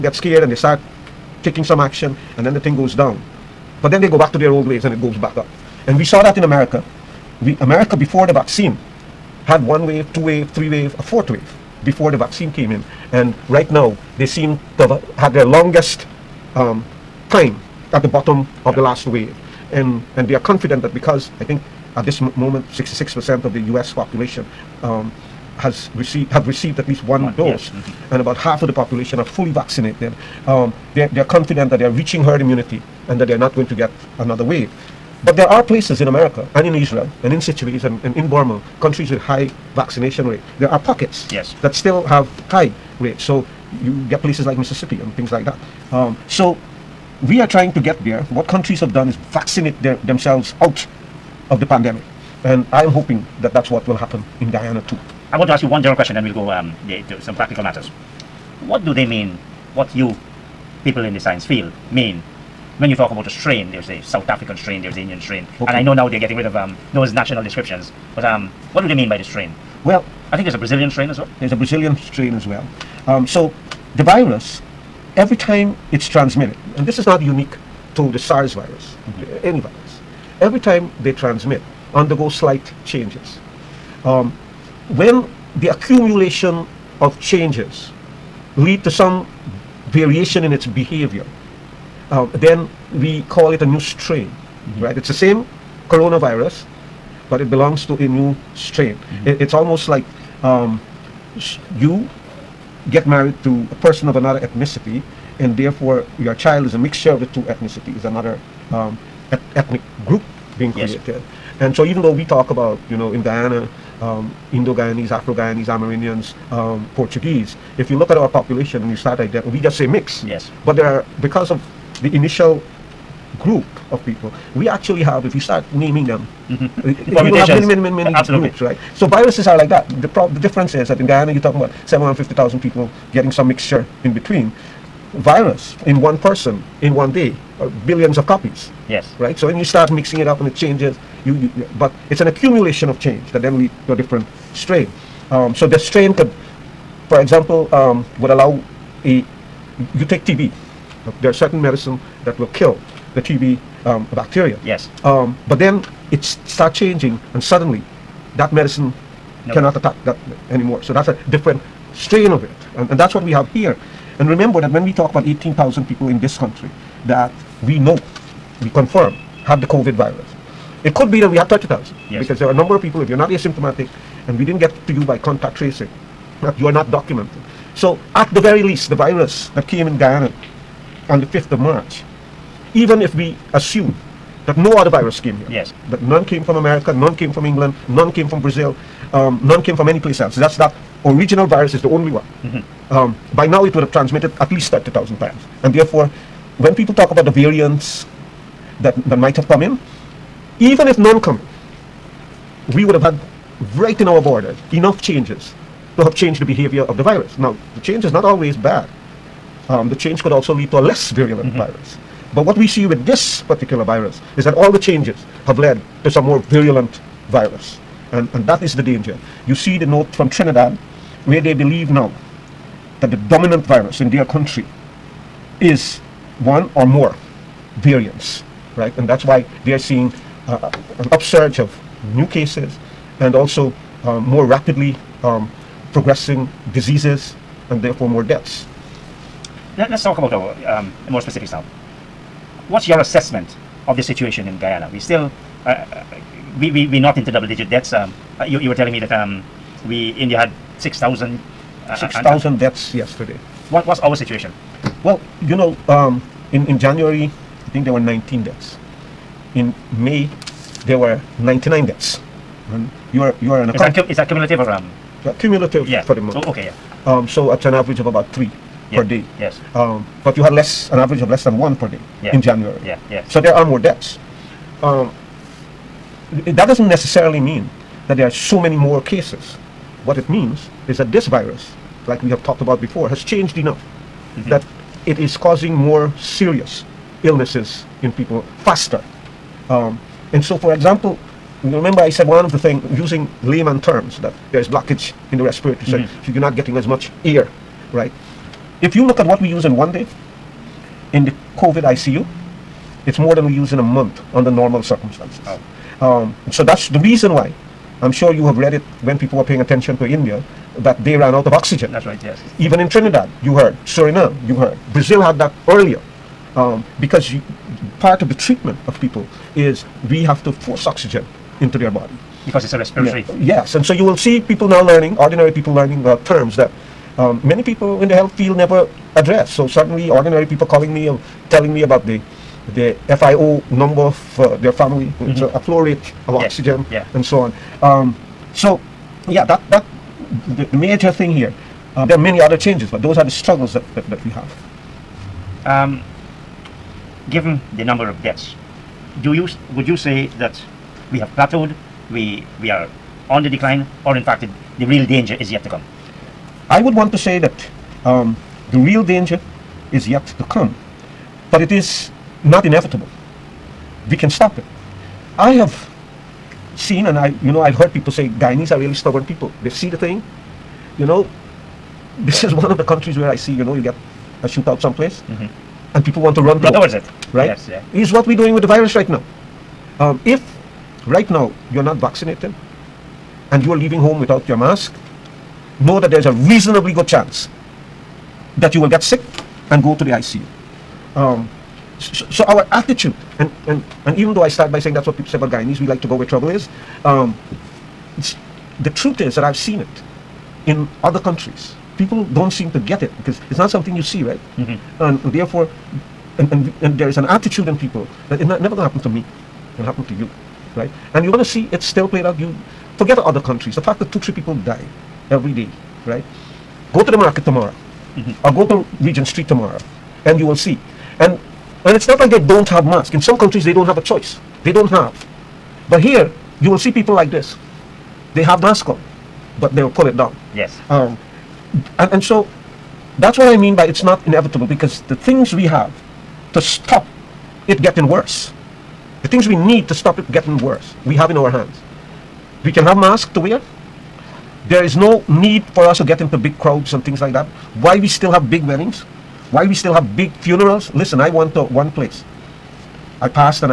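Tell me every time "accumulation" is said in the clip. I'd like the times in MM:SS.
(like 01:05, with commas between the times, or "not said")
01:25, 02:22.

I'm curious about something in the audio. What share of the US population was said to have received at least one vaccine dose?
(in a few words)
66%.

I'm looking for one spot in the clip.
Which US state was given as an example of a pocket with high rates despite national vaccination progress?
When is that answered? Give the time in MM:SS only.
00:44.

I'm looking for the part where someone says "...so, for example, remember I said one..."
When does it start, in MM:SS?
04:50.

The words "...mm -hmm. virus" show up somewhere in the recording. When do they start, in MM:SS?
03:31.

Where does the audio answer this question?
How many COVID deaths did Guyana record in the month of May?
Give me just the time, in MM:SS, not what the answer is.
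04:21.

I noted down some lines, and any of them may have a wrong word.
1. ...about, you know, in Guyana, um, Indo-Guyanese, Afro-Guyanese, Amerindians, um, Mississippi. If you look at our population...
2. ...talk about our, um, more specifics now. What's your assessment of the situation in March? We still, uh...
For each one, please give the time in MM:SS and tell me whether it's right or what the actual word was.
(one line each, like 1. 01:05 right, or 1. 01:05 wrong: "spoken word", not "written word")
1. 01:52 wrong: "Portuguese", not "Mississippi"
2. 04:00 wrong: "Guyana", not "March".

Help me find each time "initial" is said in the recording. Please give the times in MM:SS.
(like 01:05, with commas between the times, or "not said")
02:02.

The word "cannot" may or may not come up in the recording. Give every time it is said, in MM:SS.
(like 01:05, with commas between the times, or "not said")
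02:39.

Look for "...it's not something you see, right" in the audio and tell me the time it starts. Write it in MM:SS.
06:43.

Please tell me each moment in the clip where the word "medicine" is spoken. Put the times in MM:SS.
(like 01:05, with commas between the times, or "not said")
02:31, 02:38.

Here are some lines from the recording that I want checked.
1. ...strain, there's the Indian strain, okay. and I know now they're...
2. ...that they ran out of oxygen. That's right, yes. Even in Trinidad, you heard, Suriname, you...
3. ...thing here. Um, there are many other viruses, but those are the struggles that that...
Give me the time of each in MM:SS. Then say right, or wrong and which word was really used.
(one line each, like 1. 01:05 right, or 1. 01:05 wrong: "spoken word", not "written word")
1. 01:04 right
2. 05:10 right
3. 05:41 wrong: "changes", not "viruses".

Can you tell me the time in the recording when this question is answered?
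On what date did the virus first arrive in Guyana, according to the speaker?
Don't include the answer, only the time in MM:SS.
03:01.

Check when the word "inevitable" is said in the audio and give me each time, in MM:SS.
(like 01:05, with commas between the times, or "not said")
06:02, 07:14.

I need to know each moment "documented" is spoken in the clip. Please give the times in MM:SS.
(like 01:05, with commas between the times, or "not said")
02:56.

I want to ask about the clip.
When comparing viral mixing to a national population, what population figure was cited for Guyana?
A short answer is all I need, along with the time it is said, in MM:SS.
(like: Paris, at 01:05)
750,000, at 02:11.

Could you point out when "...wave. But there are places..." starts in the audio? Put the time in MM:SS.
00:34.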